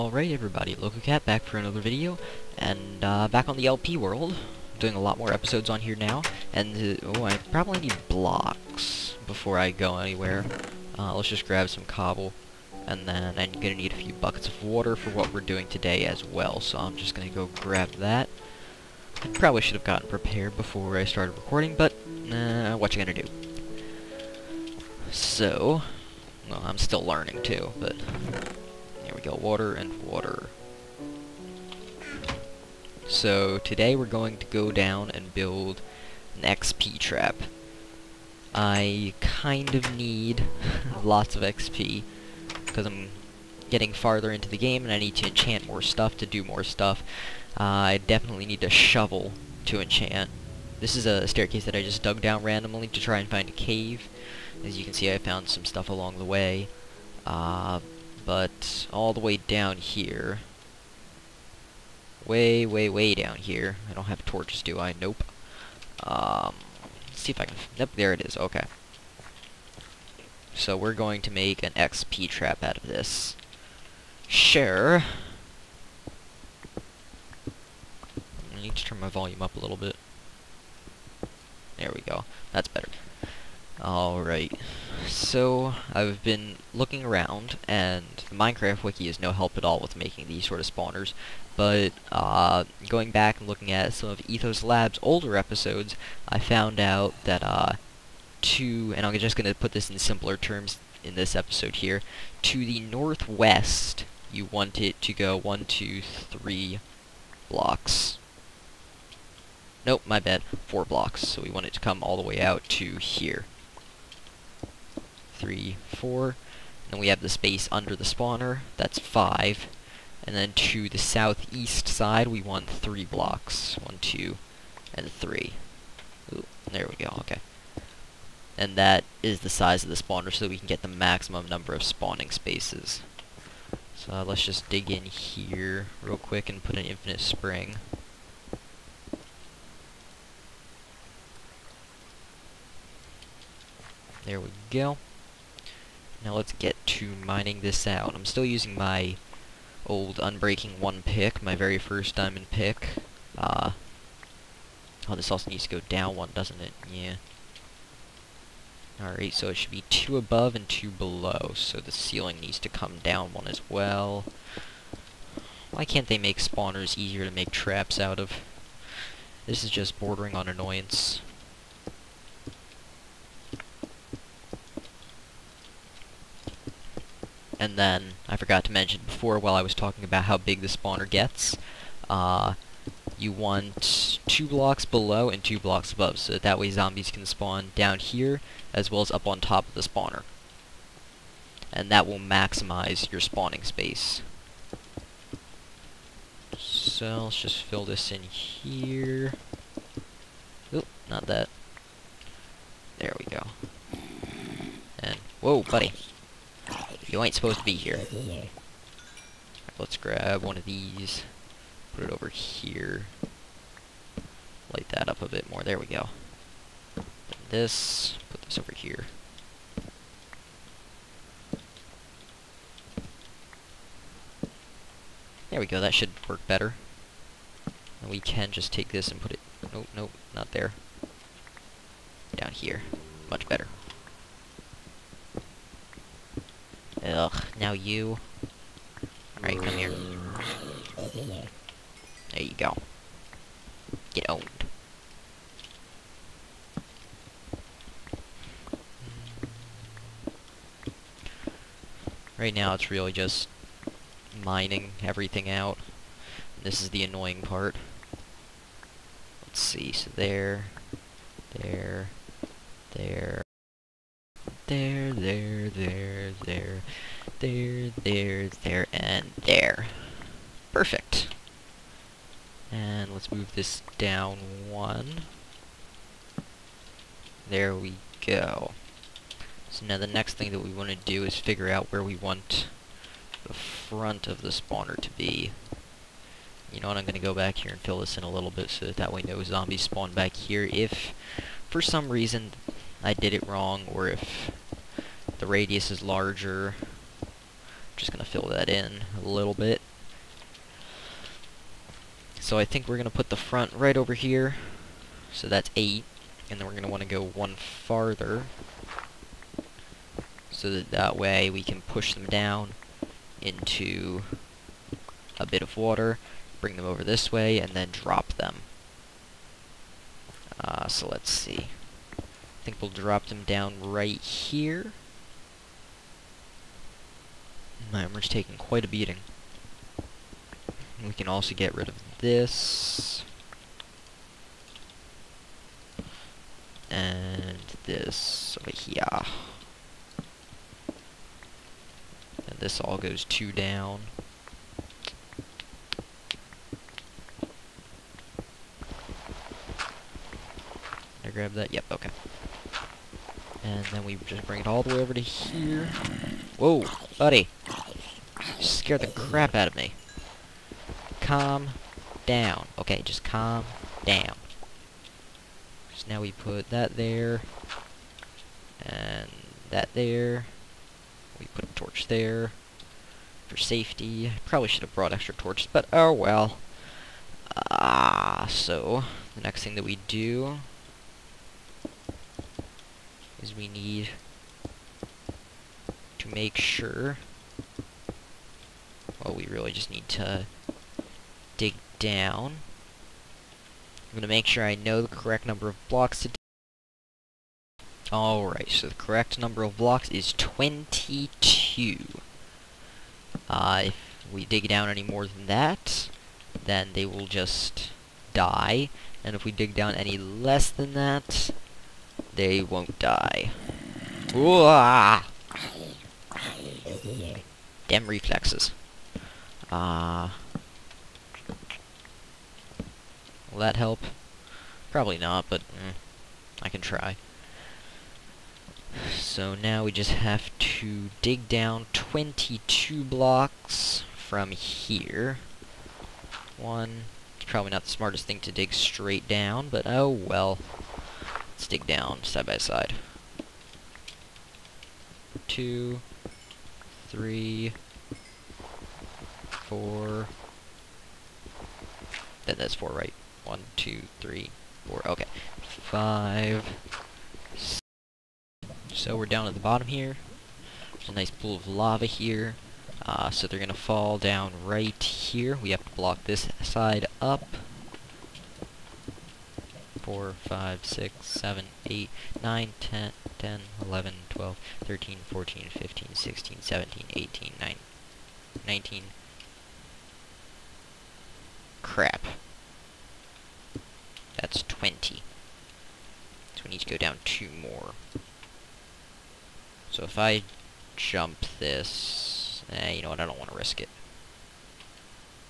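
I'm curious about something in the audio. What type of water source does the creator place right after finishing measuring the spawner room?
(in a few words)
Infinite spring.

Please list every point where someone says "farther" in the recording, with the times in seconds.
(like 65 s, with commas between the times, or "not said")
43 s, 307 s.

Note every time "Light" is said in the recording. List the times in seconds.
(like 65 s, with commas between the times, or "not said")
214 s.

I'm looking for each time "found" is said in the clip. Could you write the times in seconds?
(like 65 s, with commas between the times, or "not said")
55 s, 96 s.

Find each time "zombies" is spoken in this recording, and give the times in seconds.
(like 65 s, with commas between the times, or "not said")
186 s, 289 s.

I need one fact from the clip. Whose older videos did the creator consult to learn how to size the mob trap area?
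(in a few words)
Ethos Lab.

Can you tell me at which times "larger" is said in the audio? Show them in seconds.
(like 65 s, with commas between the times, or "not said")
296 s.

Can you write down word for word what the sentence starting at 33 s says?
So today we're going to go down and build an XP trap.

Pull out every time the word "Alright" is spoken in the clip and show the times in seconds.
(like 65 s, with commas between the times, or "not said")
83 s, 159 s, 239 s, 398 s.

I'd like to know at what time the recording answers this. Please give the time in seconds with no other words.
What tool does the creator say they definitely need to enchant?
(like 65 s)
48 s.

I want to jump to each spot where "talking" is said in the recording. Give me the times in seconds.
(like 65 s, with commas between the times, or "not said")
179 s.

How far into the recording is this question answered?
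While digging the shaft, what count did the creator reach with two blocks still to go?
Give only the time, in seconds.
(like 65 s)
484 s.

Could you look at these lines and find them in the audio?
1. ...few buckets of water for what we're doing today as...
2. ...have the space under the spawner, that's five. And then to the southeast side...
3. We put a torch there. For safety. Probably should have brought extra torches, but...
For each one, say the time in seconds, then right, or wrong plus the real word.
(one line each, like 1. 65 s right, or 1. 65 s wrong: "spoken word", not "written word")
1. 13 s right
2. 117 s right
3. 371 s right.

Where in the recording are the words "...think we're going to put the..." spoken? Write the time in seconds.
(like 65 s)
302 s.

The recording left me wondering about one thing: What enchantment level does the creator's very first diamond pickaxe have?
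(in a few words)
Unbreaking 1.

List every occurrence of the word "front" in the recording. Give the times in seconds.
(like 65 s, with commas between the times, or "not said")
283 s, 303 s.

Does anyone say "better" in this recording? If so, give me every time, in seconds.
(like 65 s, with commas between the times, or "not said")
82 s, 226 s, 233 s.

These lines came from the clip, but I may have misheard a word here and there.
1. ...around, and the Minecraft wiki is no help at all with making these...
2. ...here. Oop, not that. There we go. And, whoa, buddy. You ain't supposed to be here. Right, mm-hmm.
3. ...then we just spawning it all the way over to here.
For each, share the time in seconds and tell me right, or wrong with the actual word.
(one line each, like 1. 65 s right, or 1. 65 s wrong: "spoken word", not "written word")
1. 87 s right
2. 198 s right
3. 353 s wrong: "bring", not "spawning".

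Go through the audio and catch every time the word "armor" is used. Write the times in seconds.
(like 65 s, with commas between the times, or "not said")
328 s.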